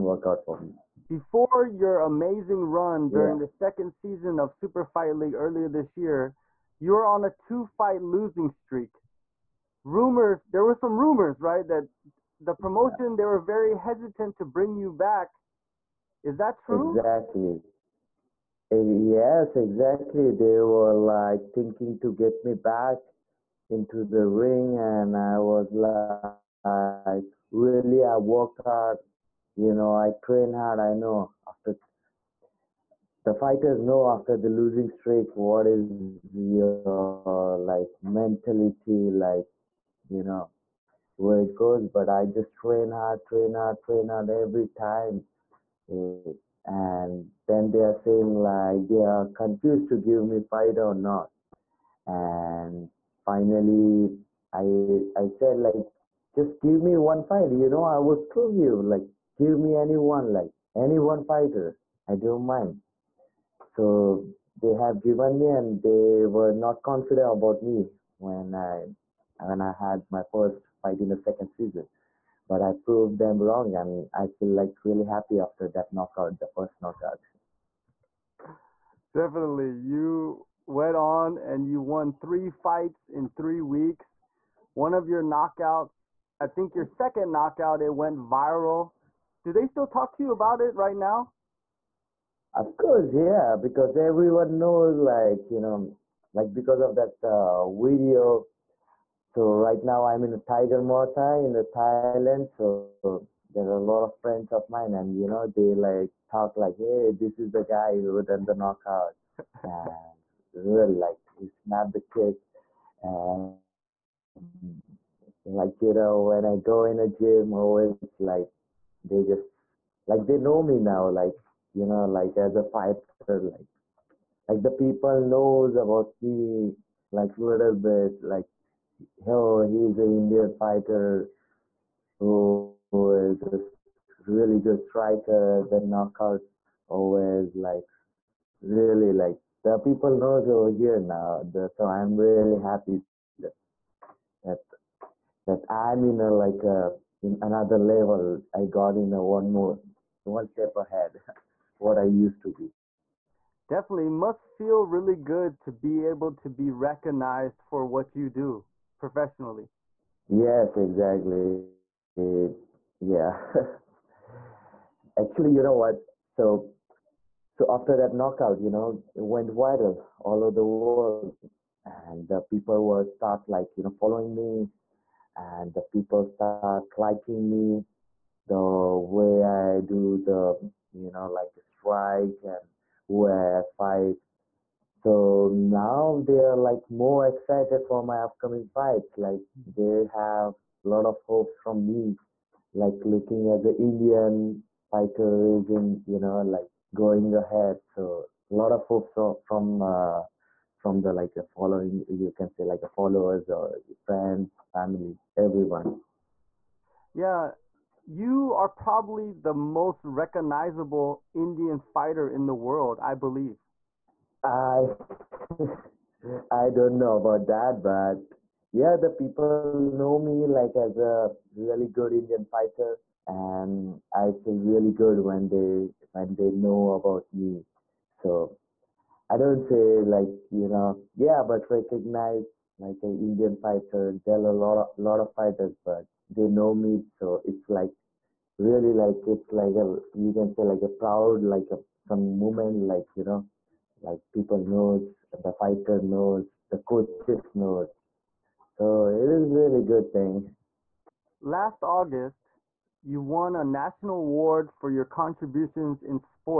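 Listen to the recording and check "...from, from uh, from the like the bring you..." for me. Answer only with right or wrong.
wrong.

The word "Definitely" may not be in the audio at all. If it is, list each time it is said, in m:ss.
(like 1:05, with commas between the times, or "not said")
1:19, 2:33.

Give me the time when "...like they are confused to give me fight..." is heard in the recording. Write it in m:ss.
0:48.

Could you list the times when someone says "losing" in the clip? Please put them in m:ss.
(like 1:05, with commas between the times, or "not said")
0:08, 0:34.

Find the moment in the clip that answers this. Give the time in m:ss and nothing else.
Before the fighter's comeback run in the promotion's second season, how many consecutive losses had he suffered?
0:07.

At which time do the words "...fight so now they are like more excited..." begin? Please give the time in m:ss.
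3:03.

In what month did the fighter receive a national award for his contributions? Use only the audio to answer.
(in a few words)
August.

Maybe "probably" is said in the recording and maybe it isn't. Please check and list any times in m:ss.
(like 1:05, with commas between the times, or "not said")
3:28.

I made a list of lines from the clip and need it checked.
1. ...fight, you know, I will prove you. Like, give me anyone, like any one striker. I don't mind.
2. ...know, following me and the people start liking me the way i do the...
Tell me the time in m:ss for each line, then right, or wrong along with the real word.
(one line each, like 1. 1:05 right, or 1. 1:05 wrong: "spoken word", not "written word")
1. 0:57 wrong: "fighter", not "striker"
2. 2:53 right.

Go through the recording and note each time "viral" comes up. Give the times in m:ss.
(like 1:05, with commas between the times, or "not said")
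1:28, 2:49.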